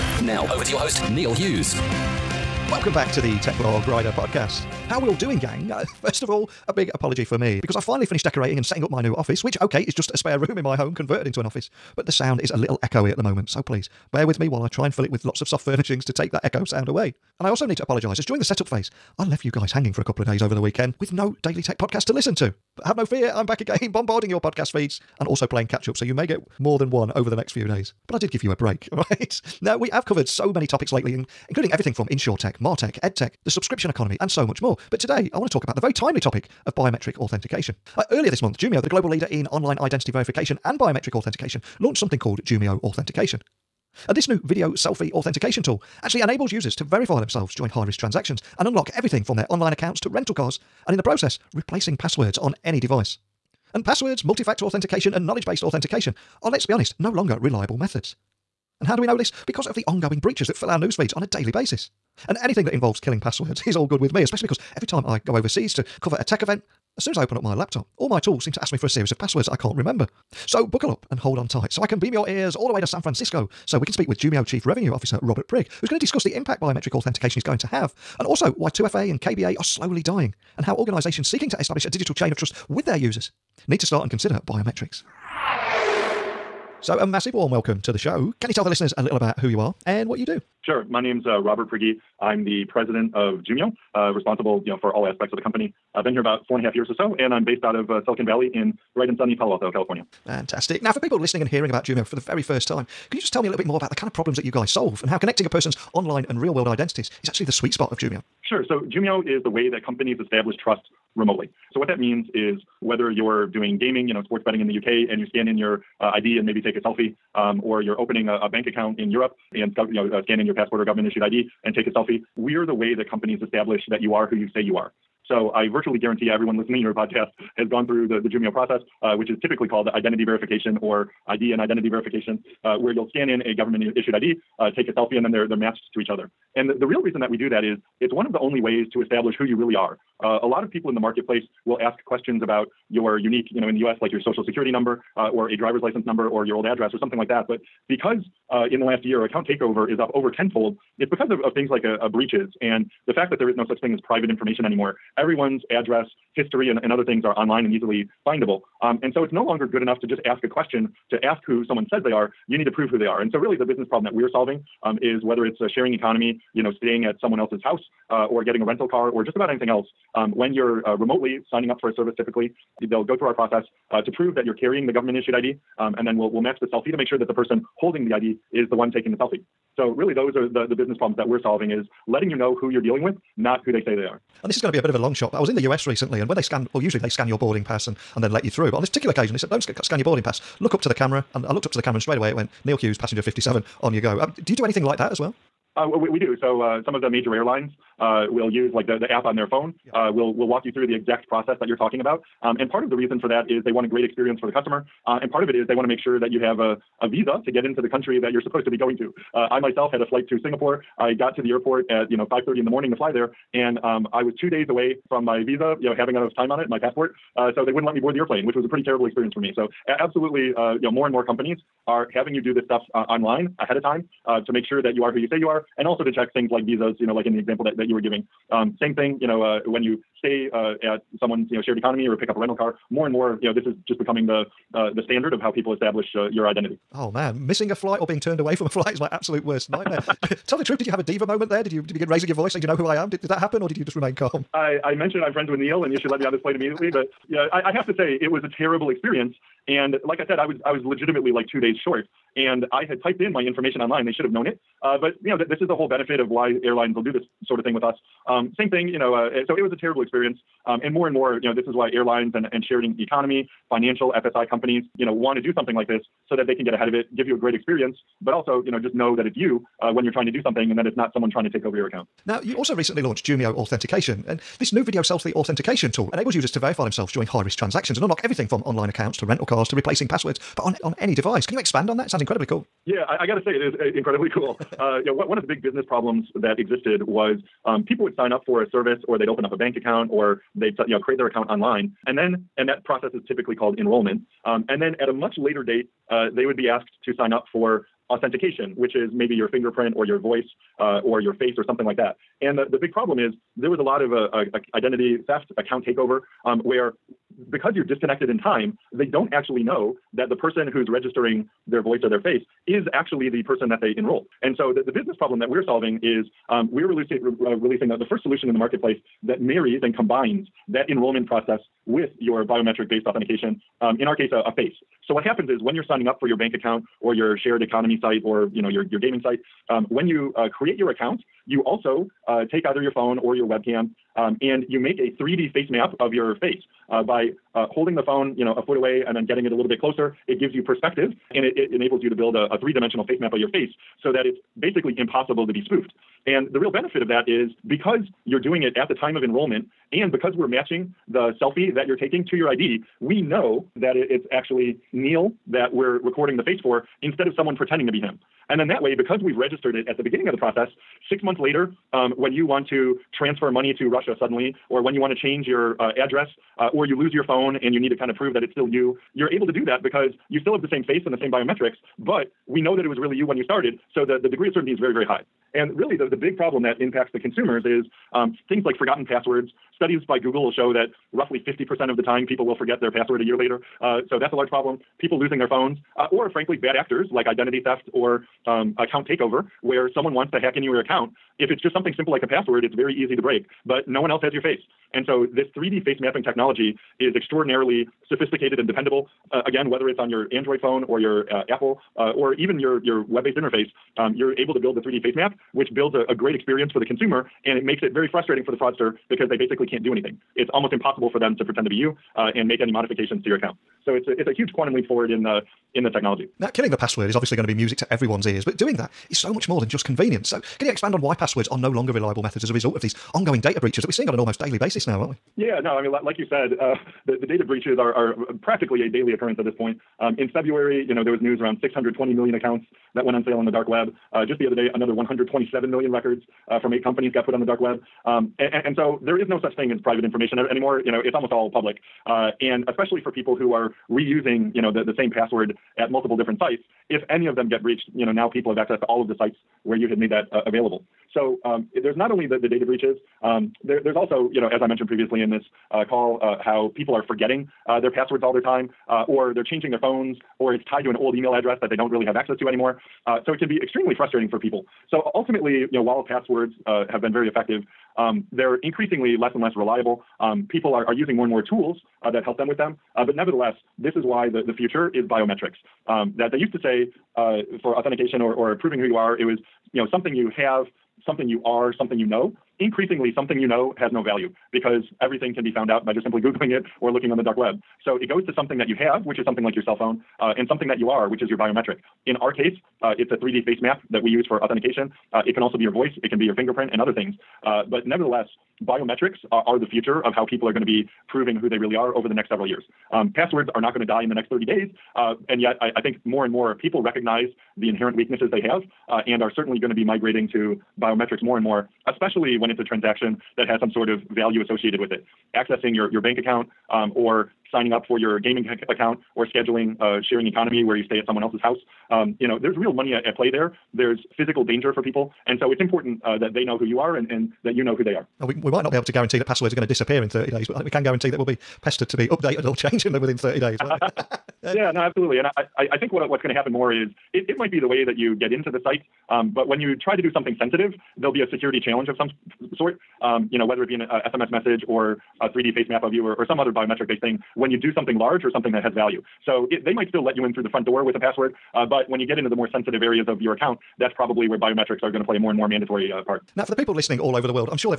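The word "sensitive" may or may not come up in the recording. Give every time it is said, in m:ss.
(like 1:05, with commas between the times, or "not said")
9:00, 9:12.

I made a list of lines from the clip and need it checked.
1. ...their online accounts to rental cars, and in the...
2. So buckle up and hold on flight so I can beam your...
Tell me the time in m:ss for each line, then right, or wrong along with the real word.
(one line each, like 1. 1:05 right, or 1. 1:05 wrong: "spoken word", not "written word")
1. 0:49 right
2. 1:10 wrong: "tight", not "flight".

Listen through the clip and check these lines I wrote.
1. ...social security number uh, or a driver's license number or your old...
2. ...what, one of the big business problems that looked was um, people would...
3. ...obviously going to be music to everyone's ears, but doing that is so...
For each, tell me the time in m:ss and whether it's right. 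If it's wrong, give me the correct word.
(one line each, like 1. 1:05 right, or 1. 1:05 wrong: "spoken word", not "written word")
1. 2:24 right
2. 4:45 wrong: "existed", not "looked"
3. 6:57 right.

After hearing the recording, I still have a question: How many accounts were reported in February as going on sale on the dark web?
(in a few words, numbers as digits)
620 million.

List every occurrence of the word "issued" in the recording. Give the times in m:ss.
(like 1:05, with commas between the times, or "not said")
2:01, 2:13, 2:55.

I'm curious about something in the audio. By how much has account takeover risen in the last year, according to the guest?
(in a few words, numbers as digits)
over tenfold.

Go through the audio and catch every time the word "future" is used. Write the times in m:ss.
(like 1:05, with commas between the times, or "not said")
7:54, 8:19.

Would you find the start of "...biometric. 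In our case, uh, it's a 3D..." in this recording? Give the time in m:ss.
8:11.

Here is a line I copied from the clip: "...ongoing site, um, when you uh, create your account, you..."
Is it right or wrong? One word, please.
wrong.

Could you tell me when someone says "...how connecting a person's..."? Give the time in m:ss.
1:45.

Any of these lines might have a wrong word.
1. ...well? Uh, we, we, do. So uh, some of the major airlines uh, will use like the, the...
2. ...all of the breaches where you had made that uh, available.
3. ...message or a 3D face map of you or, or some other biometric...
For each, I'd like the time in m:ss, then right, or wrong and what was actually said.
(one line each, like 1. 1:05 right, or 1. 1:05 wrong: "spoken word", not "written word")
1. 3:15 right
2. 7:28 wrong: "sites", not "breaches"
3. 9:04 right.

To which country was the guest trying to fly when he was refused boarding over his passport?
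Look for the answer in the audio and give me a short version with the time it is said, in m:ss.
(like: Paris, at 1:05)
Singapore, at 3:30.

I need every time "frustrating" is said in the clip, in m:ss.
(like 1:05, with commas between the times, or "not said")
6:48, 7:43.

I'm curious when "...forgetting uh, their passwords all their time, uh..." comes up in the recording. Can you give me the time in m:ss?
7:37.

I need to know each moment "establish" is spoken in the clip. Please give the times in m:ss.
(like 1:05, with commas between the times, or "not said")
1:21, 1:50, 2:03, 2:19, 3:55.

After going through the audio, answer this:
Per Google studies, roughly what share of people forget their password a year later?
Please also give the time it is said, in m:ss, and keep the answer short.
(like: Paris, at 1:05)
50%, at 6:21.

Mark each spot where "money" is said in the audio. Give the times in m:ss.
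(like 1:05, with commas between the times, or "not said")
6:03, 8:42.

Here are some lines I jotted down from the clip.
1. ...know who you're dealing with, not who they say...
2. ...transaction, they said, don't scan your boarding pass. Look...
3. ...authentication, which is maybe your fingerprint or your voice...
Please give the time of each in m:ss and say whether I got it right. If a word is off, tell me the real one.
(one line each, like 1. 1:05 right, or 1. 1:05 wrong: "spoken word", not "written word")
1. 3:02 right
2. 3:09 wrong: "occasion", not "transaction"
3. 4:58 right.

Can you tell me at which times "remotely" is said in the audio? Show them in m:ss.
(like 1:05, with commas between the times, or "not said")
1:51, 2:50.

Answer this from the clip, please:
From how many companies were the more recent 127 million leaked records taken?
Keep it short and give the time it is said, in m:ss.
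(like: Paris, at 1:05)
8, at 7:16.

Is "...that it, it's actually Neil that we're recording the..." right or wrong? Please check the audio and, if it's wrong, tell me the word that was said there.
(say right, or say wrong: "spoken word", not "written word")
right.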